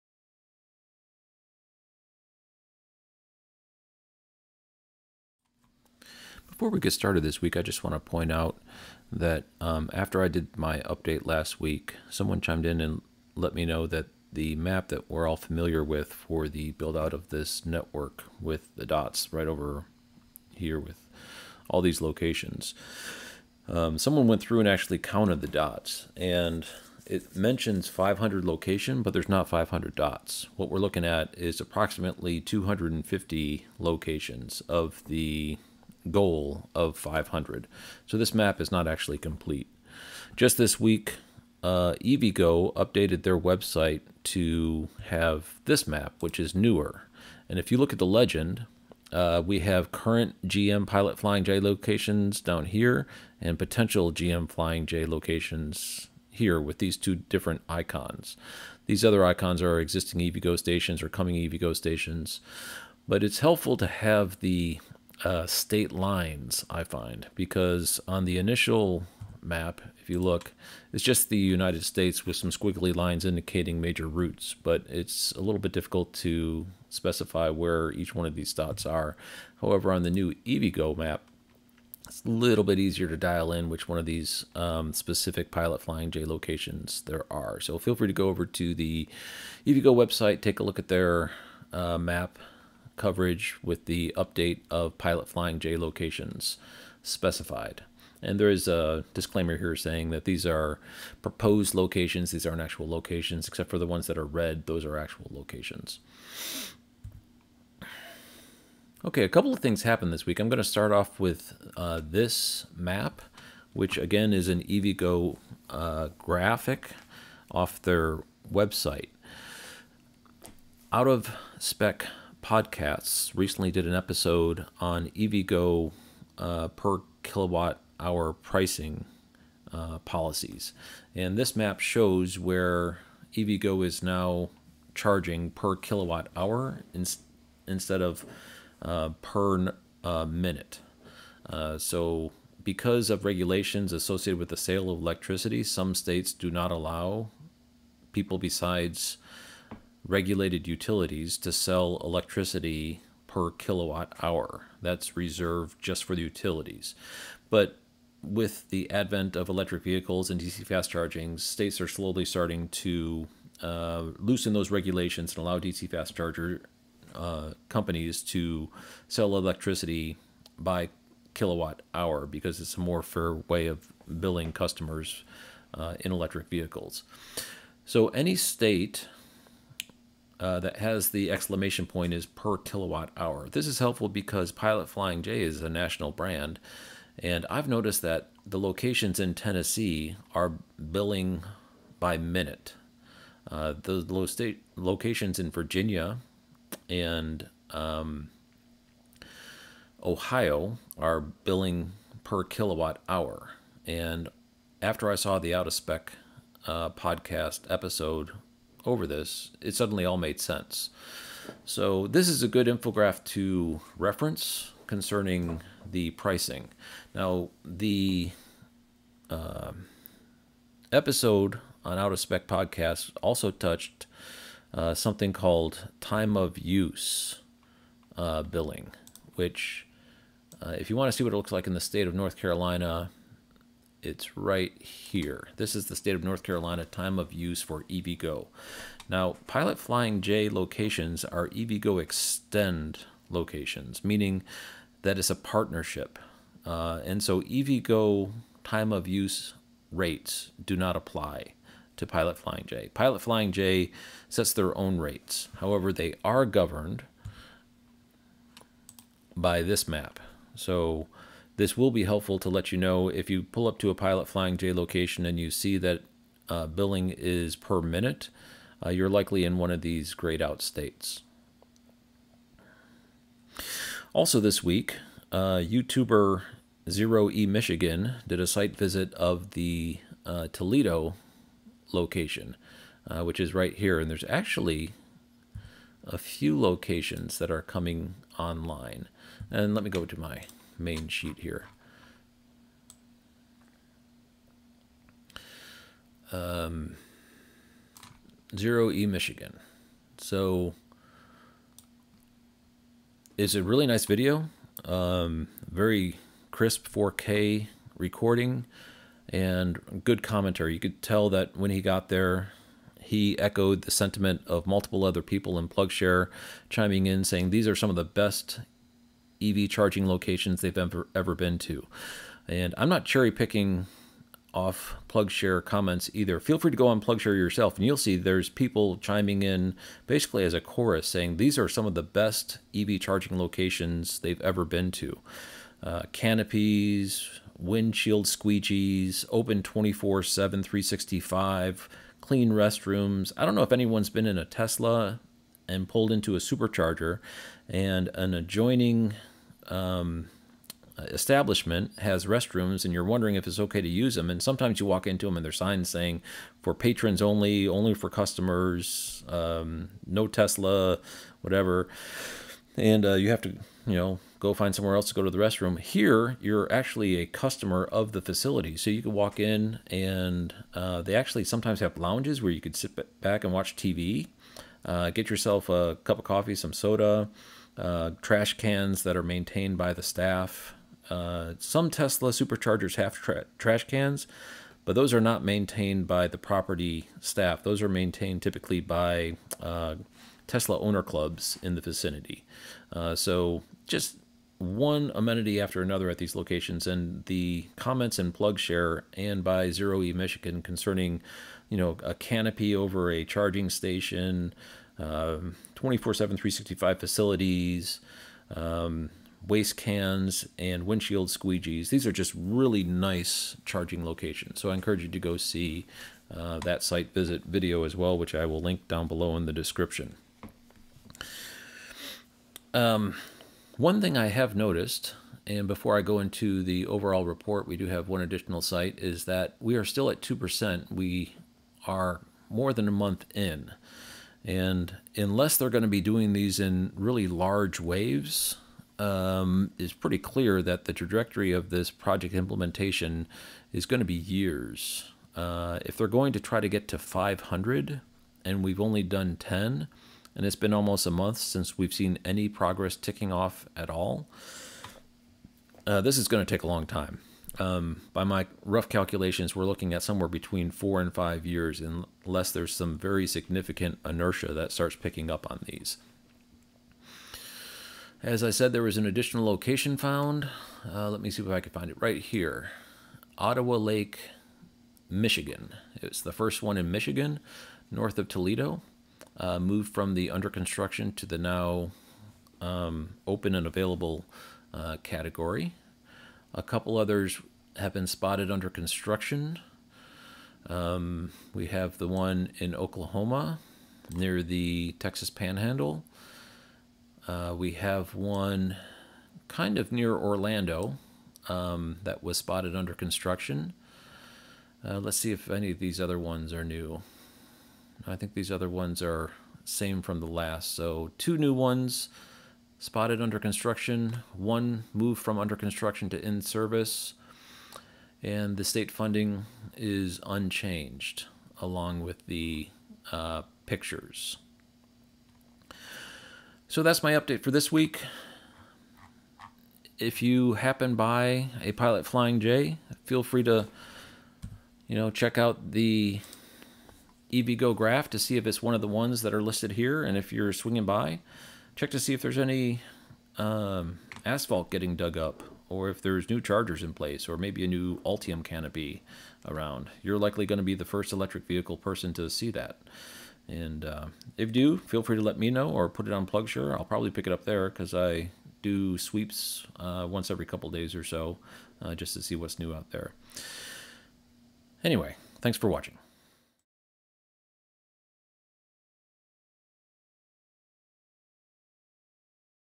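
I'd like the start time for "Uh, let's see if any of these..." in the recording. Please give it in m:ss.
8:24.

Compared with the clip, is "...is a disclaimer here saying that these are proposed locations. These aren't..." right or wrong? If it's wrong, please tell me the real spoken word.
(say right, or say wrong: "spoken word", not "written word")
right.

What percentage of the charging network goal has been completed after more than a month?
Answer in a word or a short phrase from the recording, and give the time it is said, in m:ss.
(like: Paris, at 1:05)
2%, at 7:10.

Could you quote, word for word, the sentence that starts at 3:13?
Uh, the low state locations in Virginia and um, Ohio are billing per kilowatt hour.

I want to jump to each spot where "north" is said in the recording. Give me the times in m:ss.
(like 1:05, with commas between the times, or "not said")
3:52, 3:56, 7:57.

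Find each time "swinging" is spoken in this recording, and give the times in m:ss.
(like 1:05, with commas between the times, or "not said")
9:00.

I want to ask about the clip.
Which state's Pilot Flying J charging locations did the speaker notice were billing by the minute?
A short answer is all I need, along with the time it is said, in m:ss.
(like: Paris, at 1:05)
Tennessee, at 3:09.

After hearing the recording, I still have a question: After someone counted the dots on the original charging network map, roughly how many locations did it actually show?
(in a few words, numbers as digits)
250.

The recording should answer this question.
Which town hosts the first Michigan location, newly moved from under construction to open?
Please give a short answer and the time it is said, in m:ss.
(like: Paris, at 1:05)
Ottawa Lake, at 7:53.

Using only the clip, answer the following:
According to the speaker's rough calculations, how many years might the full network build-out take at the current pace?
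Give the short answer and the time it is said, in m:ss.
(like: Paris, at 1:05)
4 to 5 years, at 7:40.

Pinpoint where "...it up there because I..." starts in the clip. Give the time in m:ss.
9:17.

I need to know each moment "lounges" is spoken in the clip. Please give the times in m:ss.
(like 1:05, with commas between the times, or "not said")
6:11.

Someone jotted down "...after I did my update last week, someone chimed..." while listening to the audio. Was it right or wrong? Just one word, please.
right.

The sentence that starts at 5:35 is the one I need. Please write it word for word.
Uh, canopies, windshield squeegees, open 24 7, 365, clean restrooms.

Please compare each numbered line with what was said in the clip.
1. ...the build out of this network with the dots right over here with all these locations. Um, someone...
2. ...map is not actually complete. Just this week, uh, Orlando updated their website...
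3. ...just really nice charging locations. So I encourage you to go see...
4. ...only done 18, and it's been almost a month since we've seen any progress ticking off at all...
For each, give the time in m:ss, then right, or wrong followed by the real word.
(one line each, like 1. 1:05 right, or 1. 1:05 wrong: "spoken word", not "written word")
1. 0:16 right
2. 0:38 wrong: "EVGO", not "Orlando"
3. 6:52 right
4. 7:28 wrong: "10", not "18".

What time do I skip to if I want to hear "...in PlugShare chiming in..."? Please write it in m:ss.
5:15.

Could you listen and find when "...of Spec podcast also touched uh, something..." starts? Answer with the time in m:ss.
3:42.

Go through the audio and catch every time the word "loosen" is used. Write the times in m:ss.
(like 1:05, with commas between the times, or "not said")
2:44.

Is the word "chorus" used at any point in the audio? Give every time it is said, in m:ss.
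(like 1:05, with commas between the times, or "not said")
5:30.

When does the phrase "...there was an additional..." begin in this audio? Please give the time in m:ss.
7:48.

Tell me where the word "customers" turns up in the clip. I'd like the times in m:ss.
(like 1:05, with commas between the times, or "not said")
2:54, 5:58, 6:07.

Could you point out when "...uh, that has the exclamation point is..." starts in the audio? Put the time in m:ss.
3:00.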